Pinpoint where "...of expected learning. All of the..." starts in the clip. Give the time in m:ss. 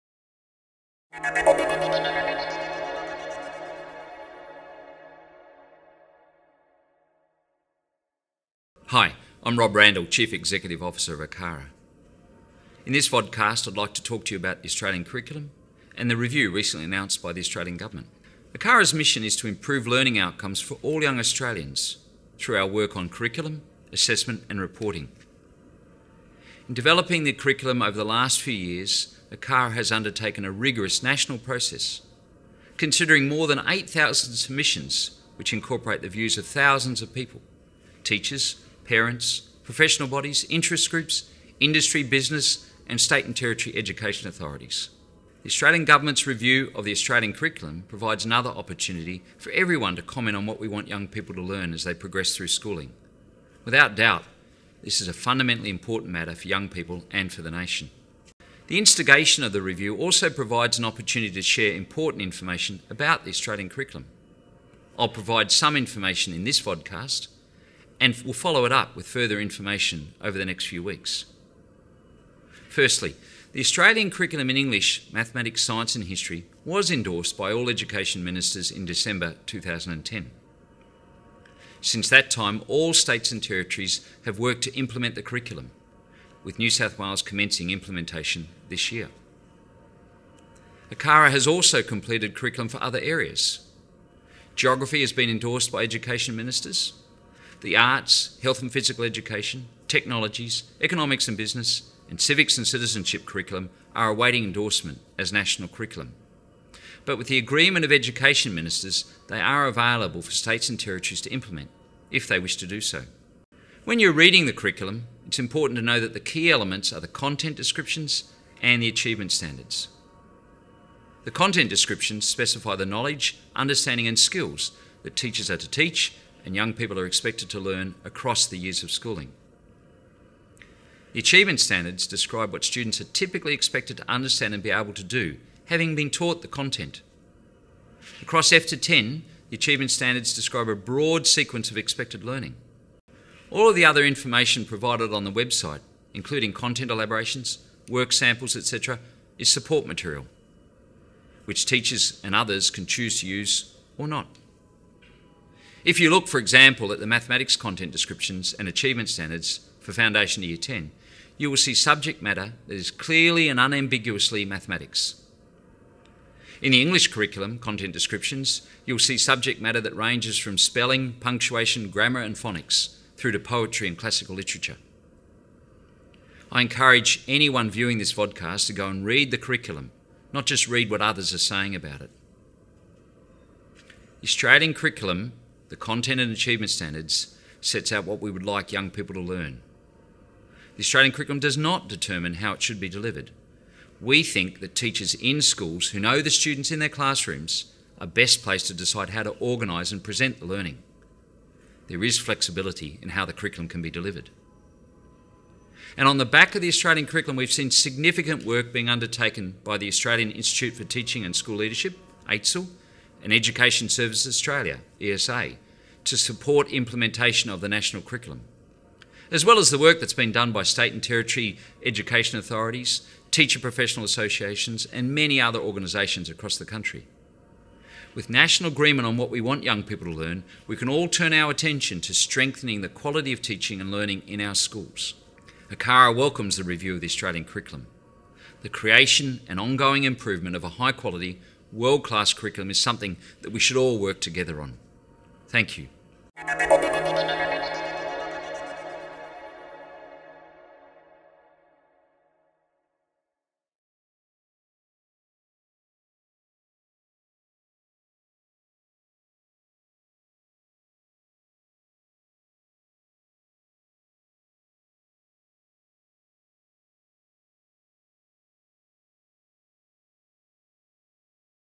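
2:21.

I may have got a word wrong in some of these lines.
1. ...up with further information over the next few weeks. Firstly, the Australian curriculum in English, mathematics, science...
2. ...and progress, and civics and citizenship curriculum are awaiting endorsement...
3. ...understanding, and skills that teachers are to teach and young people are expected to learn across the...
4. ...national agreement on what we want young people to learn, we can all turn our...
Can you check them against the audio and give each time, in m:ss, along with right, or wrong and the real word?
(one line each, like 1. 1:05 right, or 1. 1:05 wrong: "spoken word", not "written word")
1. 1:08 right
2. 1:41 wrong: "business", not "progress"
3. 2:03 right
4. 3:48 right.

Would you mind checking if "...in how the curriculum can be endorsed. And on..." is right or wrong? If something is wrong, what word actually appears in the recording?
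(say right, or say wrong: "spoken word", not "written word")
wrong: "delivered", not "endorsed".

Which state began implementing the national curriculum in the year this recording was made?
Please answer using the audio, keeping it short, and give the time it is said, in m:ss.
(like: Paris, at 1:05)
New South Wales, at 1:26.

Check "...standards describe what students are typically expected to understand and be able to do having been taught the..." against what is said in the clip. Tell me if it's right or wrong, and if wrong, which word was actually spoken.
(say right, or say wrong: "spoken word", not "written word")
right.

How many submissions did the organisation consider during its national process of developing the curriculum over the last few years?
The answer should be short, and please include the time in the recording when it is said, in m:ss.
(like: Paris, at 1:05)
8,000, at 0:33.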